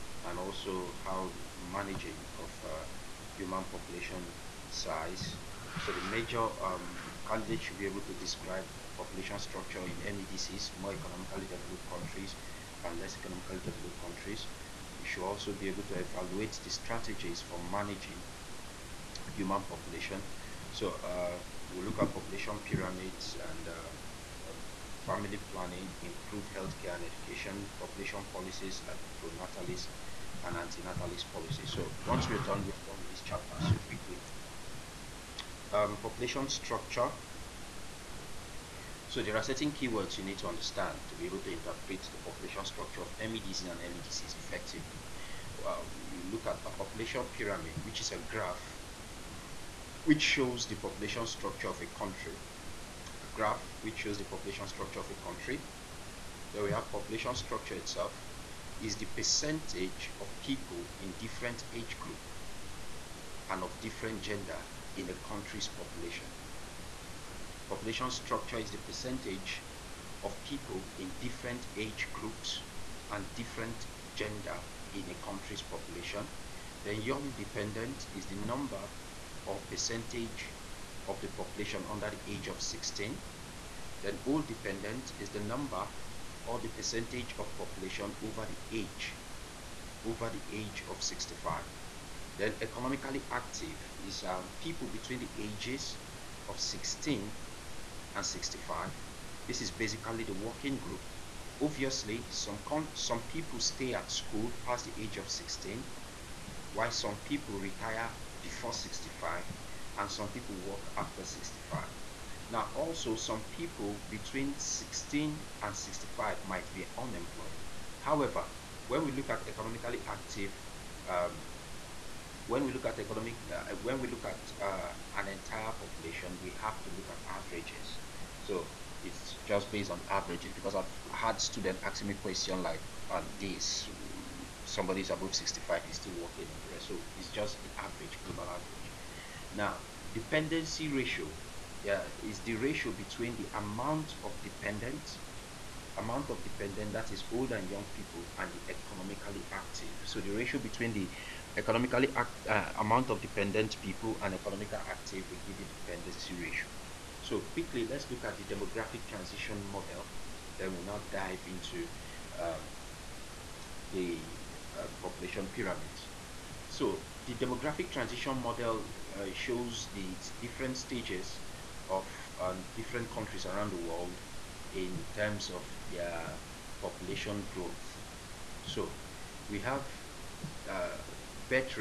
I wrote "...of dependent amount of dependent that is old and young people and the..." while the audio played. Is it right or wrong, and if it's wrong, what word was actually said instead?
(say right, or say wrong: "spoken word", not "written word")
right.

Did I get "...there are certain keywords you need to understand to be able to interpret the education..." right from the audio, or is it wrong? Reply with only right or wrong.
wrong.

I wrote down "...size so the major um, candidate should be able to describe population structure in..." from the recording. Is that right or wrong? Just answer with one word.
right.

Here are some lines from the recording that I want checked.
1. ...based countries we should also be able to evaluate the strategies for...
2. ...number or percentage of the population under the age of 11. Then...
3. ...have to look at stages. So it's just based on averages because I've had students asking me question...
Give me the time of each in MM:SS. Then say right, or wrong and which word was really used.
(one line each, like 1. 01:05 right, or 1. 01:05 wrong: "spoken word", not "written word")
1. 00:13 wrong: "developed", not "based"
2. 01:18 wrong: "16", not "11"
3. 02:06 wrong: "averages", not "stages".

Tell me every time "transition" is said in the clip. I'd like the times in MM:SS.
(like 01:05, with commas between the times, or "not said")
02:39, 02:47.